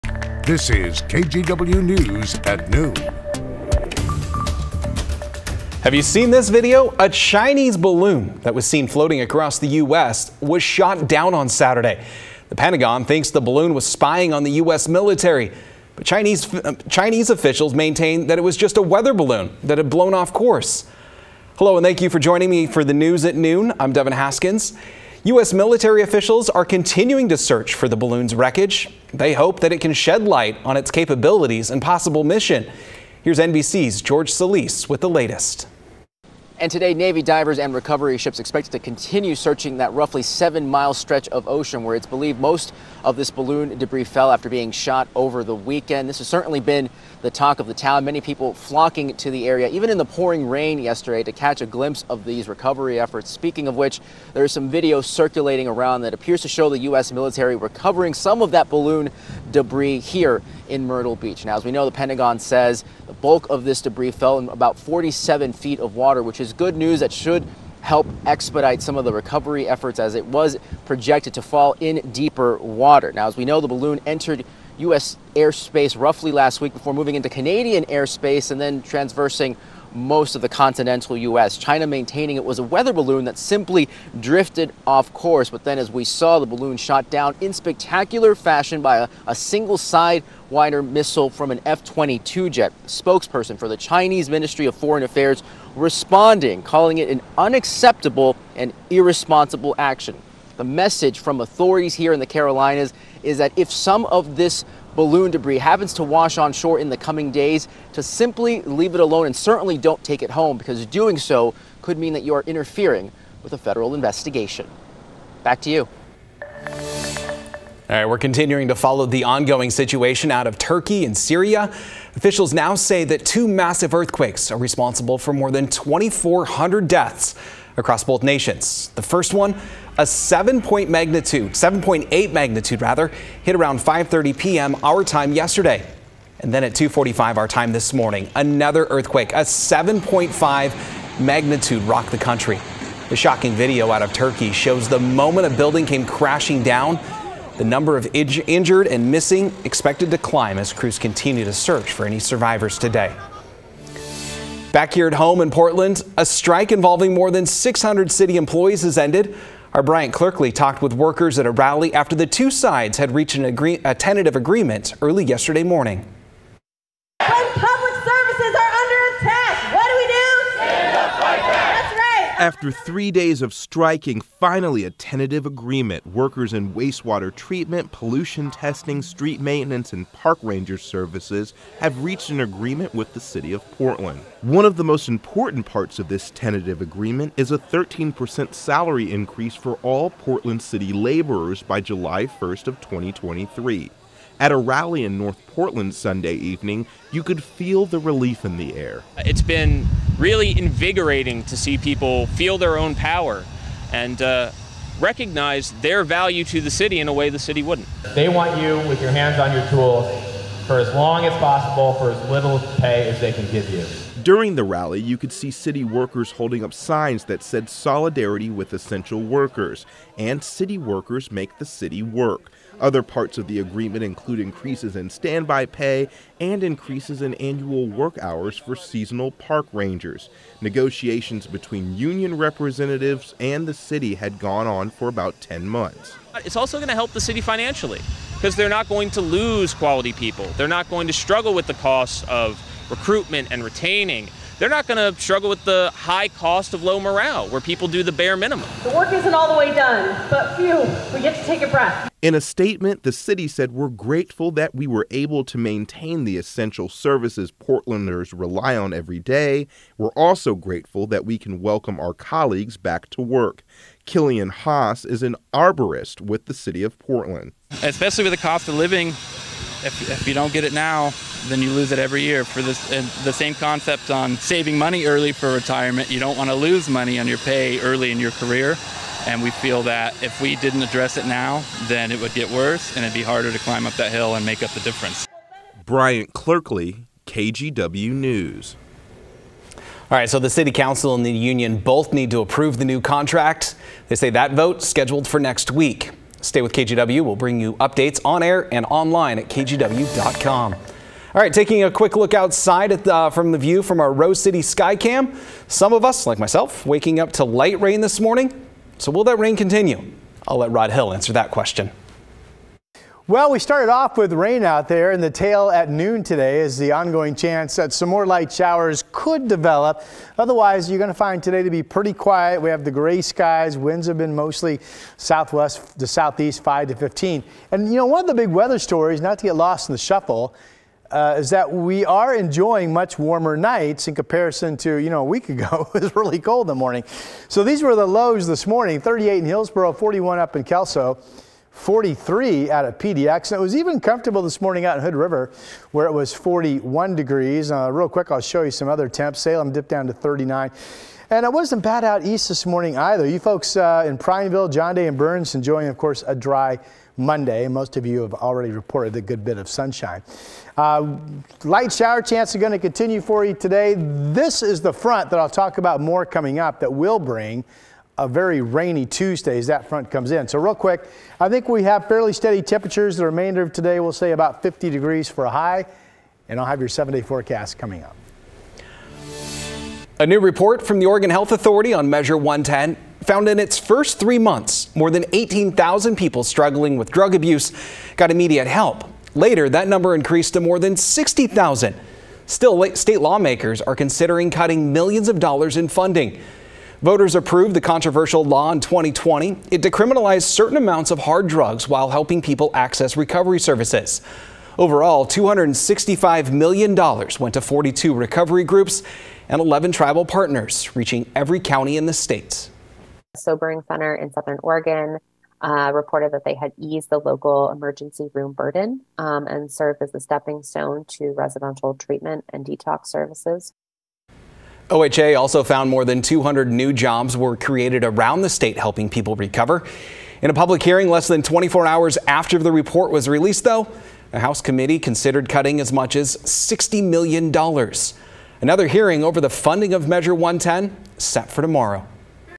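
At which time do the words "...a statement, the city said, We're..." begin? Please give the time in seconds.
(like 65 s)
252 s.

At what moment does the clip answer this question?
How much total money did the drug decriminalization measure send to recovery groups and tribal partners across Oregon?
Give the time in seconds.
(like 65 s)
405 s.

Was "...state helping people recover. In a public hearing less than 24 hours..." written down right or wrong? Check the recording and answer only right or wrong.
right.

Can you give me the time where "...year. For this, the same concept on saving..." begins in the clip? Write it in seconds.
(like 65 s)
272 s.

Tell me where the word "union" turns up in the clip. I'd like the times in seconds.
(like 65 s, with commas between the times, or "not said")
231 s, 291 s.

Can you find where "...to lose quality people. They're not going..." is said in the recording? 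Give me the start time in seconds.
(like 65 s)
239 s.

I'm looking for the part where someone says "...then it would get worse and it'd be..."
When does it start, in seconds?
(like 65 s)
281 s.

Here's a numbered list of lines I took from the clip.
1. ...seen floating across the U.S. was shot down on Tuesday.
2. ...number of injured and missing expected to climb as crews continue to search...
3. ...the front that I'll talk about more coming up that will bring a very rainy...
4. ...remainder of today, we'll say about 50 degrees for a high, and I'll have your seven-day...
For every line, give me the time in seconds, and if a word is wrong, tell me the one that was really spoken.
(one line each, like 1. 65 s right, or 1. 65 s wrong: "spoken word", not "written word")
1. 8 s wrong: "Saturday", not "Tuesday"
2. 147 s right
3. 364 s right
4. 373 s right.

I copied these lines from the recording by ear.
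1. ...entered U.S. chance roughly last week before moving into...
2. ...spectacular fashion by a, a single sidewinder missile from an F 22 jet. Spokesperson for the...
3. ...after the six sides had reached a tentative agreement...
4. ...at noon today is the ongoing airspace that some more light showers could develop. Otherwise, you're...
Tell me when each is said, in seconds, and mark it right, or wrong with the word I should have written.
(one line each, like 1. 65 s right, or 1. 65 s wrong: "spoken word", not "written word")
1. 74 s wrong: "airspace", not "chance"
2. 87 s right
3. 161 s wrong: "two", not "six"
4. 315 s wrong: "chance", not "airspace".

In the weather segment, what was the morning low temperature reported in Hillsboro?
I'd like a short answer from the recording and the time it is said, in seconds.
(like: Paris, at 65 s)
38, at 338 s.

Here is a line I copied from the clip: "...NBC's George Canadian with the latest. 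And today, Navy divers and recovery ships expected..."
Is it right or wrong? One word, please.
wrong.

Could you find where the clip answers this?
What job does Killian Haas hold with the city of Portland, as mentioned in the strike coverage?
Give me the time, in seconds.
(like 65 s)
265 s.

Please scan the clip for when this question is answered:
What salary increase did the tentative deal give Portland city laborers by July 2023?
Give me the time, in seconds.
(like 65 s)
187 s.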